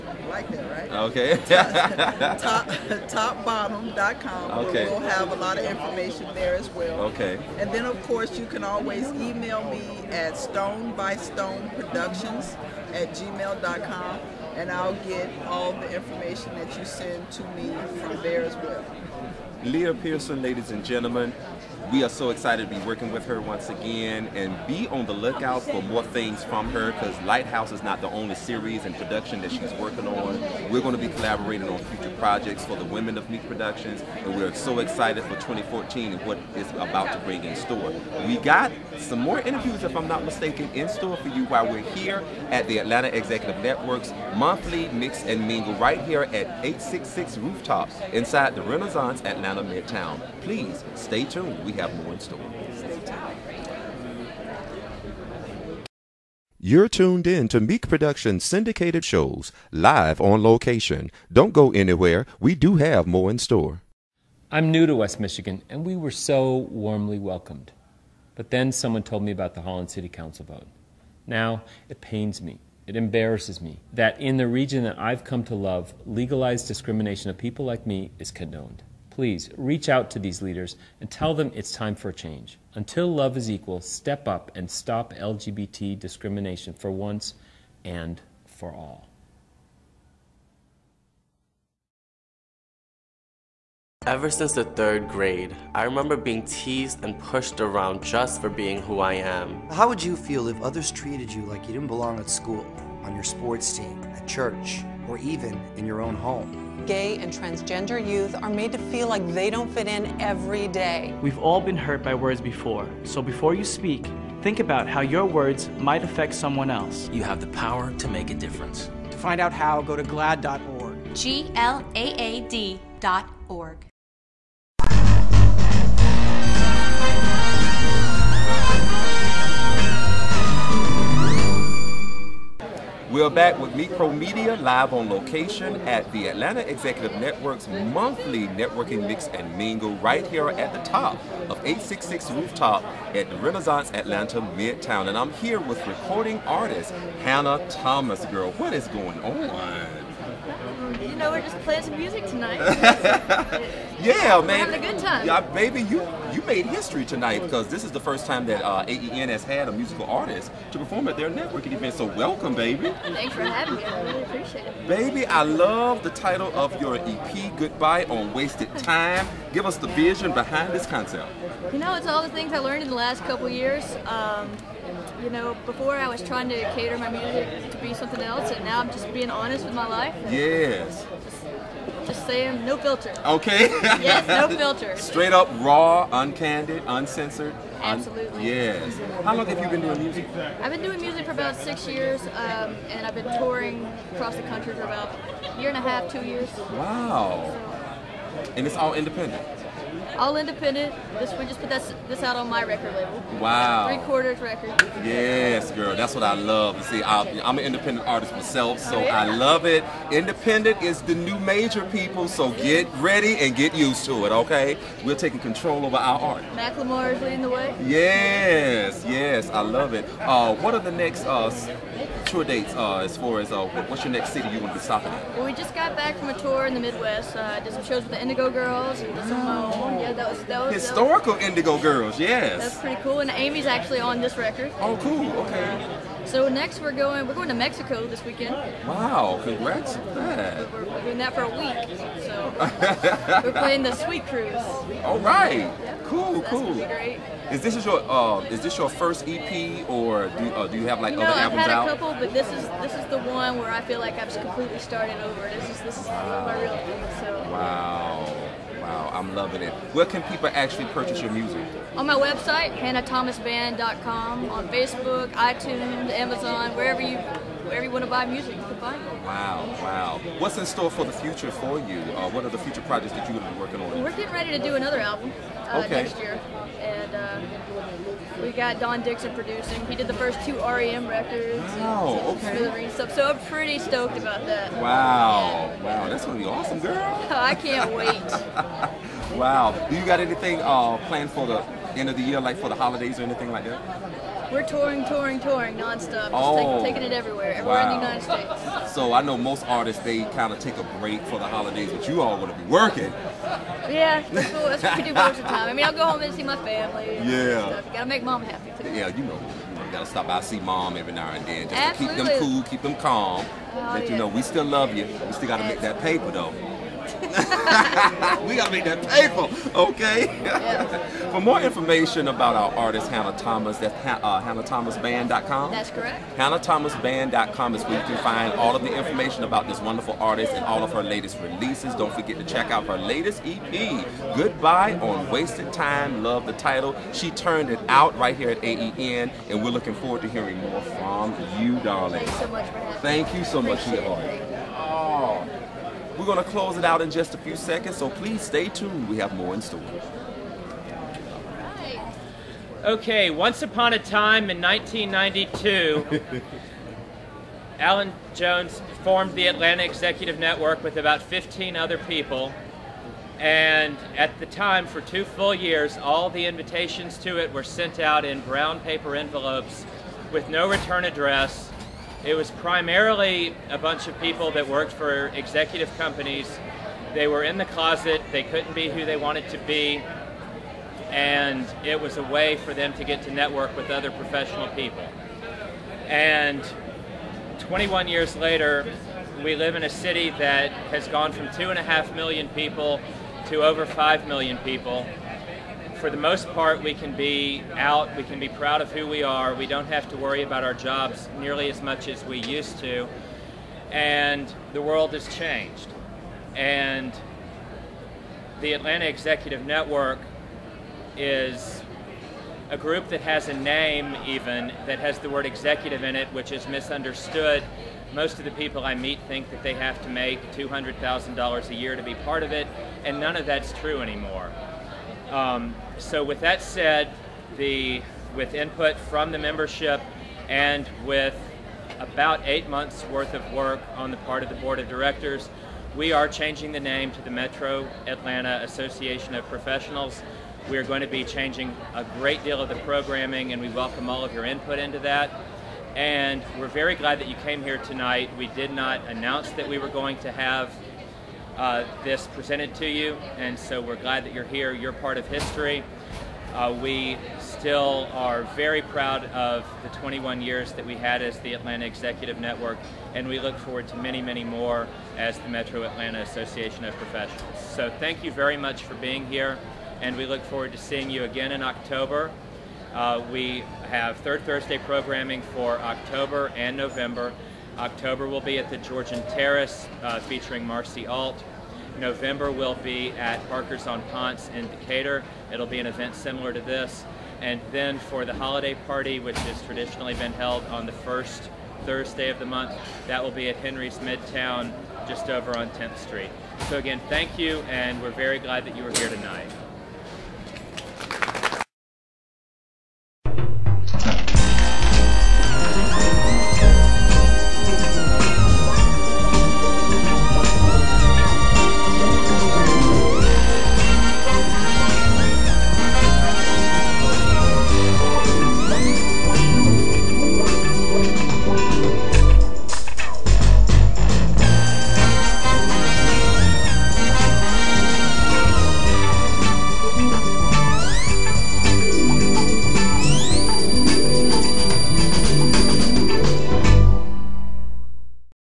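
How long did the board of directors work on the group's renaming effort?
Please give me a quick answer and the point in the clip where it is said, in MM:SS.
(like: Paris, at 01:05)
8 months, at 07:12.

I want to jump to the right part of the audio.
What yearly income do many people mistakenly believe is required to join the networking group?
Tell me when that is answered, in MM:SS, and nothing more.
07:00.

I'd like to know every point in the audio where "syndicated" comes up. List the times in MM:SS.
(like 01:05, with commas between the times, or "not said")
00:58.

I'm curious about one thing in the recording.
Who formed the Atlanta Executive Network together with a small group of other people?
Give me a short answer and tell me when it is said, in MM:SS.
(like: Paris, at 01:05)
Alan Jones, at 05:57.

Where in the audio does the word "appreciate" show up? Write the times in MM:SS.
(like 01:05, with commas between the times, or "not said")
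02:44, 05:43.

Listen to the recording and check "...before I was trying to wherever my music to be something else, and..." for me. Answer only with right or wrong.
wrong.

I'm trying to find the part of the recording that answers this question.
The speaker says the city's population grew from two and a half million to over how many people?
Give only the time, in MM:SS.
06:33.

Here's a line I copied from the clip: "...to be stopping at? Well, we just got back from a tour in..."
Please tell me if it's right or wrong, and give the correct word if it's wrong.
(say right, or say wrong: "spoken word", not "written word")
right.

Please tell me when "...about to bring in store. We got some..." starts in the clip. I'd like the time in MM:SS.
00:36.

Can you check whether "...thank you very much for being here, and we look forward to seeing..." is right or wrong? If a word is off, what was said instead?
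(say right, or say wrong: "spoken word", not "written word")
right.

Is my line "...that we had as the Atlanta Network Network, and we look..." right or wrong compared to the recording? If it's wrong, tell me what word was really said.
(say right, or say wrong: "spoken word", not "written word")
wrong: "Executive", not "Network".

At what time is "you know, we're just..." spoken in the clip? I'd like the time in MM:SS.
02:31.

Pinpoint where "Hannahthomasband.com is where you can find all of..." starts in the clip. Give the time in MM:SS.
05:26.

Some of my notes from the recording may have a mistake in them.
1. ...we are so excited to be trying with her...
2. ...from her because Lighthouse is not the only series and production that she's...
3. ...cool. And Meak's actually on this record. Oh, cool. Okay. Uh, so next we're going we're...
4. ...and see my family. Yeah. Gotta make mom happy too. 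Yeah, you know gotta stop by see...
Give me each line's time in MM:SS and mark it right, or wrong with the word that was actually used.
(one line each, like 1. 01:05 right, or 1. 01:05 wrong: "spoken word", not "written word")
1. 00:21 wrong: "working", not "trying"
2. 00:26 right
3. 03:53 wrong: "Amy", not "Meak"
4. 05:06 right.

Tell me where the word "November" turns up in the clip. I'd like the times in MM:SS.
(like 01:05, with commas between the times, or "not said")
07:56, 08:01.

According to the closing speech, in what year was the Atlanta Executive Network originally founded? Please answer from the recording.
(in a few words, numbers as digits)
1992.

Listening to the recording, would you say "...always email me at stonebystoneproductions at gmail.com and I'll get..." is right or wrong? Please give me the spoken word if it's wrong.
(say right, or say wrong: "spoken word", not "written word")
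right.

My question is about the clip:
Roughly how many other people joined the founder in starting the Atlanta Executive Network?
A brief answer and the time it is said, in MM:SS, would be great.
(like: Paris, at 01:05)
15, at 06:01.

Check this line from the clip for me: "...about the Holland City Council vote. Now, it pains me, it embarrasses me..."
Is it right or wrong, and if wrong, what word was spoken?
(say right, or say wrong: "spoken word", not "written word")
right.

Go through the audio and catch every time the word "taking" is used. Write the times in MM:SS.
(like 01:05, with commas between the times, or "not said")
03:35, 04:56.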